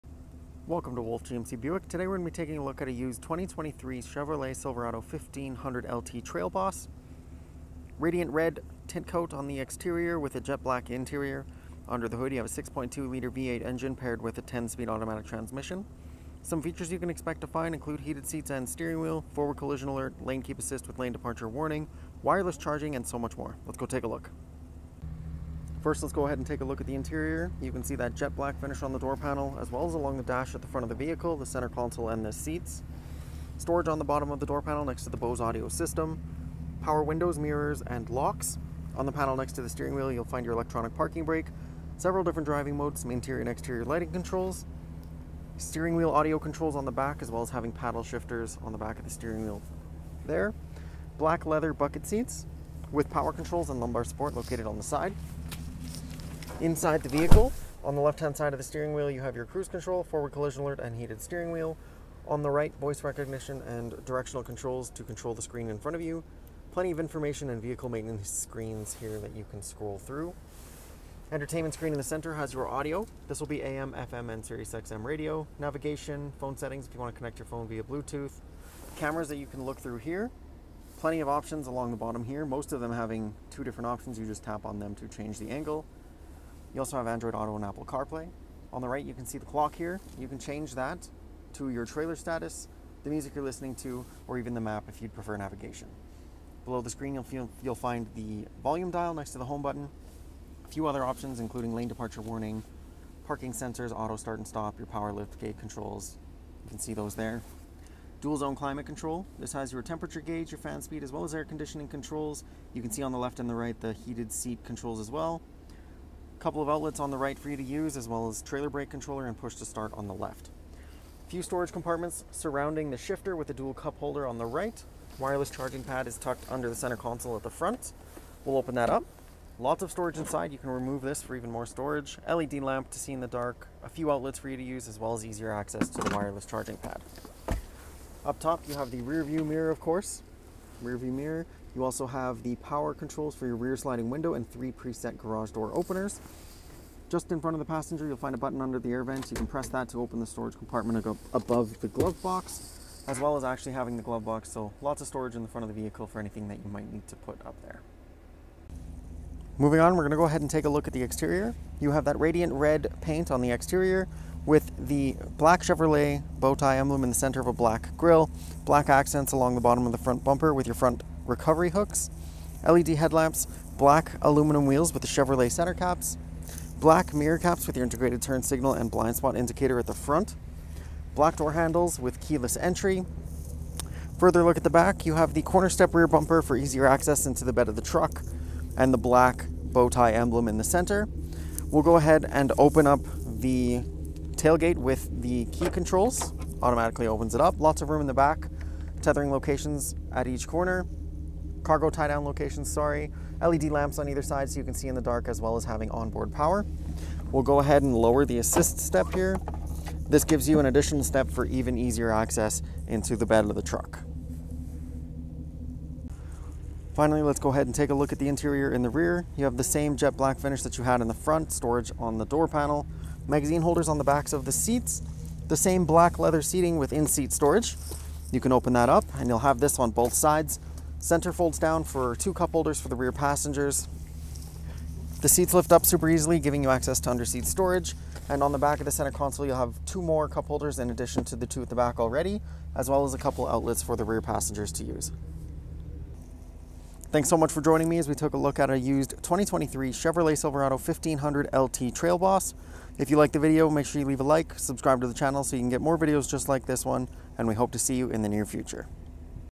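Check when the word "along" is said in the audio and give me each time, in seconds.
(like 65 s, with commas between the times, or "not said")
29 s, 81 s, 169 s.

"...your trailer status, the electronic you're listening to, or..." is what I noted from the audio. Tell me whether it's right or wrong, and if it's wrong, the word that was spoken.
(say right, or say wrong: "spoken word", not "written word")
wrong: "music", not "electronic".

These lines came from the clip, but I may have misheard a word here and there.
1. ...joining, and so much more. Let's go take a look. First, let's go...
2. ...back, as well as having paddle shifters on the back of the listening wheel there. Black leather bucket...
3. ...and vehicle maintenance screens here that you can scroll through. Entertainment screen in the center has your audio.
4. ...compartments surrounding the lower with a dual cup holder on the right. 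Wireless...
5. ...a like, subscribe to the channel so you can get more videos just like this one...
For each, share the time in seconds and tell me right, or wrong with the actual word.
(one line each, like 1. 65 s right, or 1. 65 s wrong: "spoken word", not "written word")
1. 22 s wrong: "charging", not "joining"
2. 46 s wrong: "steering", not "listening"
3. 67 s right
4. 121 s wrong: "shifter", not "lower"
5. 254 s right.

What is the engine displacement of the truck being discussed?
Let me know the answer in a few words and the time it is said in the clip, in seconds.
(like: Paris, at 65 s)
6.2 liter, at 12 s.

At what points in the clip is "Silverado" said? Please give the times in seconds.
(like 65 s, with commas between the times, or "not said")
4 s, 250 s.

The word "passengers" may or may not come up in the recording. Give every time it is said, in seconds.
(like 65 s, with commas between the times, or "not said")
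147 s, 233 s, 244 s.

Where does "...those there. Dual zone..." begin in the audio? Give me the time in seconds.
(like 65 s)
106 s.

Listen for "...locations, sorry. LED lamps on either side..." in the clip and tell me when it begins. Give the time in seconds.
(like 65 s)
202 s.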